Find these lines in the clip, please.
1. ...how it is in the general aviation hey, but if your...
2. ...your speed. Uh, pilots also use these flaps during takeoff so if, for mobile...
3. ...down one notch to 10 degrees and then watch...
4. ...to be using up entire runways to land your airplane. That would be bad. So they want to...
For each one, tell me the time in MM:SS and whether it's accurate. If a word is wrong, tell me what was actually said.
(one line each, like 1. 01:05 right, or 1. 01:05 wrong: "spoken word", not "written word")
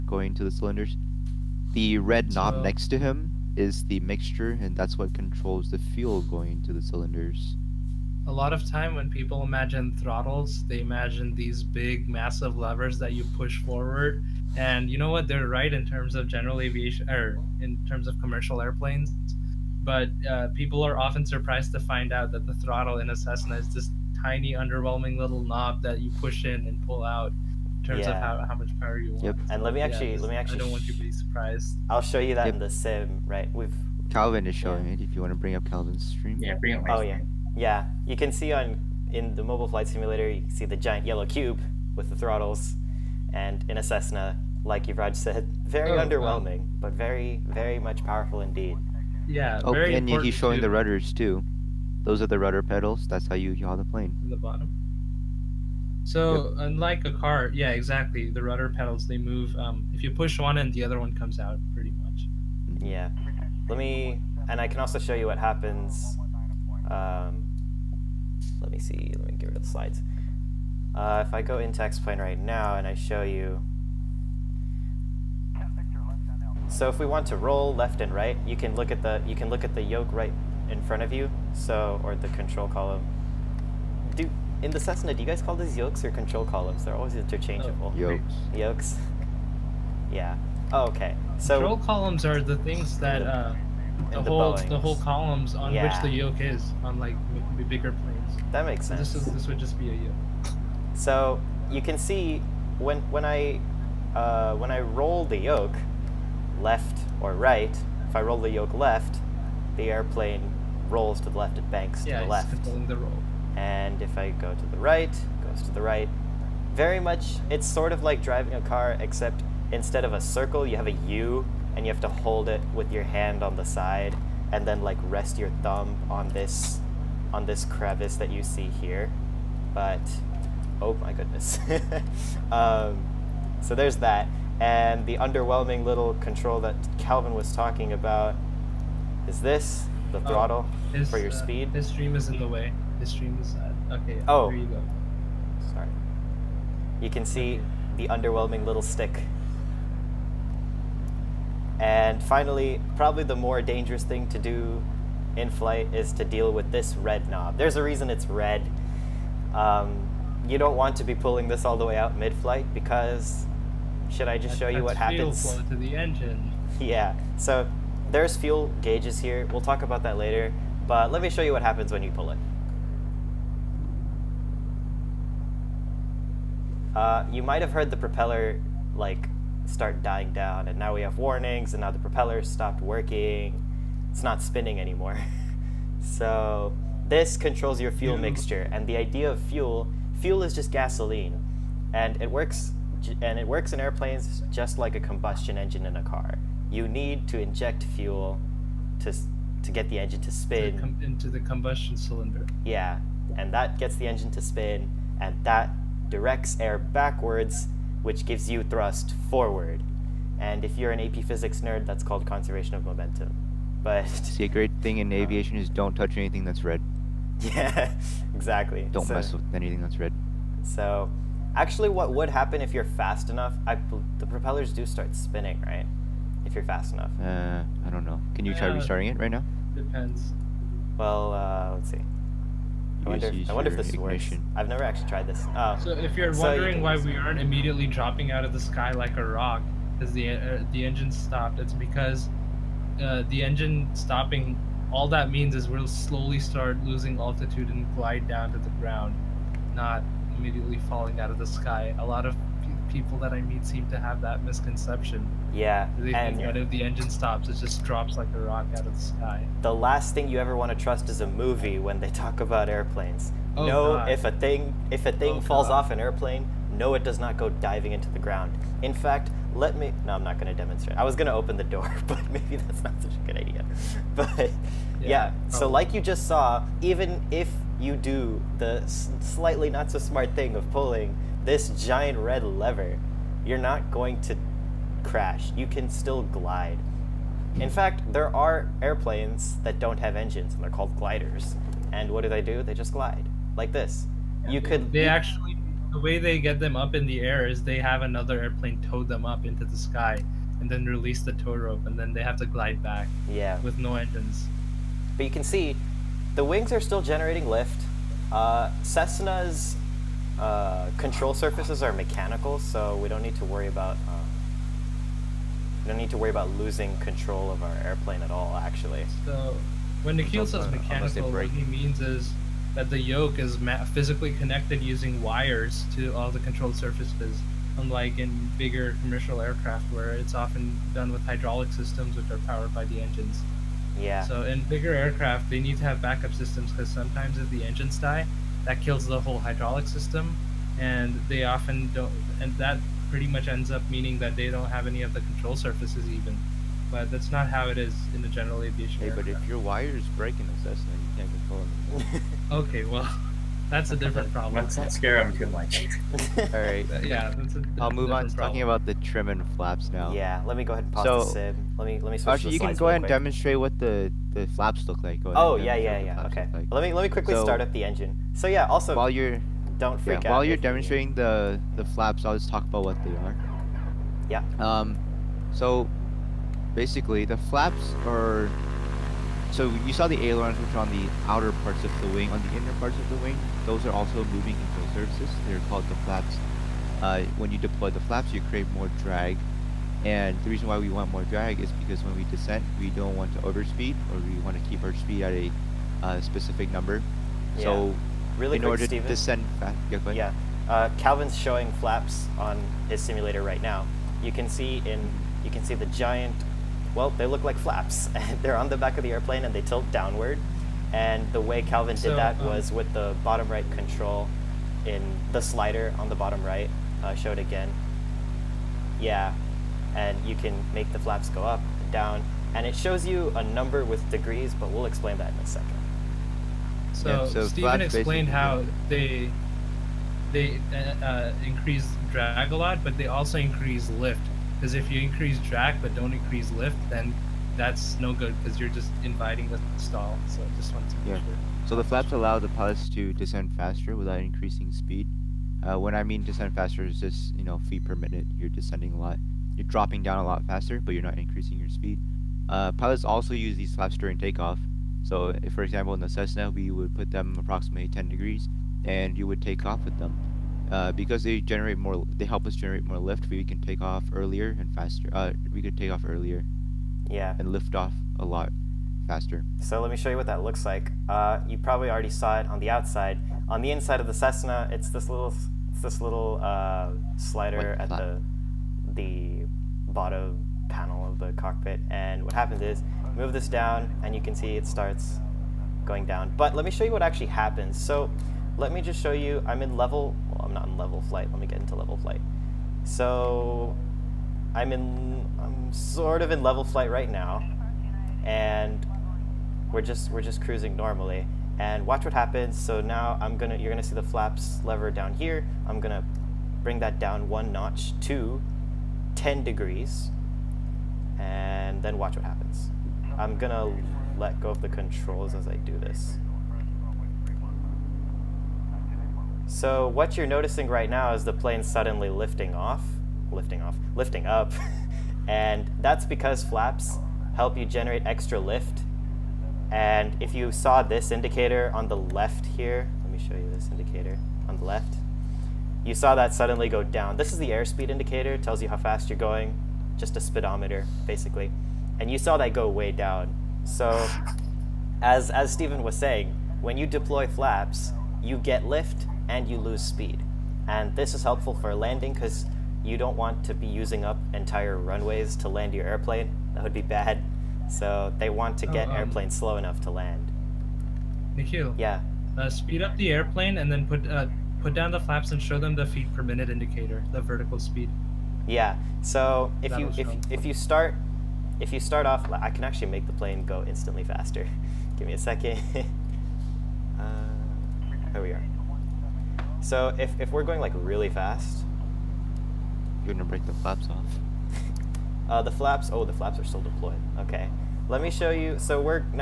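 1. 05:47 right
2. 07:31 wrong: "example", not "mobile"
3. 08:26 right
4. 09:13 right.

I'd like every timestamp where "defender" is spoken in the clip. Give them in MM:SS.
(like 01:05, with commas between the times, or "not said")
not said.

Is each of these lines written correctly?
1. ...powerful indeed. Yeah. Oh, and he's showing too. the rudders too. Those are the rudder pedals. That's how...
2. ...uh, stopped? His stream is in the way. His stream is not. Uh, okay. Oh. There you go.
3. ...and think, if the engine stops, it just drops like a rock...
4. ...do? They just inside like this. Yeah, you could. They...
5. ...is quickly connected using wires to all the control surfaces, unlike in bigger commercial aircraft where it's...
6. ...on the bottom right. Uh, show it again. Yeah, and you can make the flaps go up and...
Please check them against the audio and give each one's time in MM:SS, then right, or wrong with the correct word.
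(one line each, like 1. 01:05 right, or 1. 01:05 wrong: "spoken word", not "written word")
1. 00:48 right
2. 02:21 wrong: "speed", not "stopped"
3. 04:16 right
4. 04:52 wrong: "glide", not "inside"
5. 05:23 wrong: "physically", not "quickly"
6. 06:56 right.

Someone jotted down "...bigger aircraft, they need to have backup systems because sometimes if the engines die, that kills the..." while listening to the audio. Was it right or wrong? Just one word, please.
right.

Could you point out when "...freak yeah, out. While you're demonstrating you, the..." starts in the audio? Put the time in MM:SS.
06:09.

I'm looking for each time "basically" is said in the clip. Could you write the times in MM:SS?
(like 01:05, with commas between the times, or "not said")
06:16, 09:01.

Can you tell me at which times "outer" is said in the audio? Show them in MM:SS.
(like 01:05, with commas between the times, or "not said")
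06:21.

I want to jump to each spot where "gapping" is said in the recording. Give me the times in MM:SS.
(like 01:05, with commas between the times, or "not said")
not said.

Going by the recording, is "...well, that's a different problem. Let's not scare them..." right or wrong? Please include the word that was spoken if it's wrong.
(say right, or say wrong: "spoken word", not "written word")
right.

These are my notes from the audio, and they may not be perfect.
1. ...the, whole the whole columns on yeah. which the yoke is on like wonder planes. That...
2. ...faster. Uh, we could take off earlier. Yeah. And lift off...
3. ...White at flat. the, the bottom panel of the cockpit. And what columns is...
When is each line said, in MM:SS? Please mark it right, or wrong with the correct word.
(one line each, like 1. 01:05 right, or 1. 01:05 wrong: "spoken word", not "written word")
1. 01:34 wrong: "bigger", not "wonder"
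2. 07:44 right
3. 07:57 wrong: "happens", not "columns".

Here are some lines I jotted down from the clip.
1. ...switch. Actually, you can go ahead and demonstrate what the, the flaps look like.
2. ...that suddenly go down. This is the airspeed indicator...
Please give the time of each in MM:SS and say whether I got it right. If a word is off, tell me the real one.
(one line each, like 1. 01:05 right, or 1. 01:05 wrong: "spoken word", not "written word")
1. 06:02 right
2. 08:56 right.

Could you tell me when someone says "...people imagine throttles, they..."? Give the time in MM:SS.
00:09.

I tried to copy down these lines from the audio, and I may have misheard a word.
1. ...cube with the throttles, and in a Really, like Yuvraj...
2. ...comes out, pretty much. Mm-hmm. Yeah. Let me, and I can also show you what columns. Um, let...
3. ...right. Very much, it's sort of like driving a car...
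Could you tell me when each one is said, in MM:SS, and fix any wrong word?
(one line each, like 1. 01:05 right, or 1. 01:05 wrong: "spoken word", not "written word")
1. 00:41 wrong: "Cessna", not "Really"
2. 01:01 wrong: "happens", not "columns"
3. 01:55 right.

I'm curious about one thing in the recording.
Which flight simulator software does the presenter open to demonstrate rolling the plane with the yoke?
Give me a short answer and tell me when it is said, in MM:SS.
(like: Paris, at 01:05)
X-Plane, at 01:11.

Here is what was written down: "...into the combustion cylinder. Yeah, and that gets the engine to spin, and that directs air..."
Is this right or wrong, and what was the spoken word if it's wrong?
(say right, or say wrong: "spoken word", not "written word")
right.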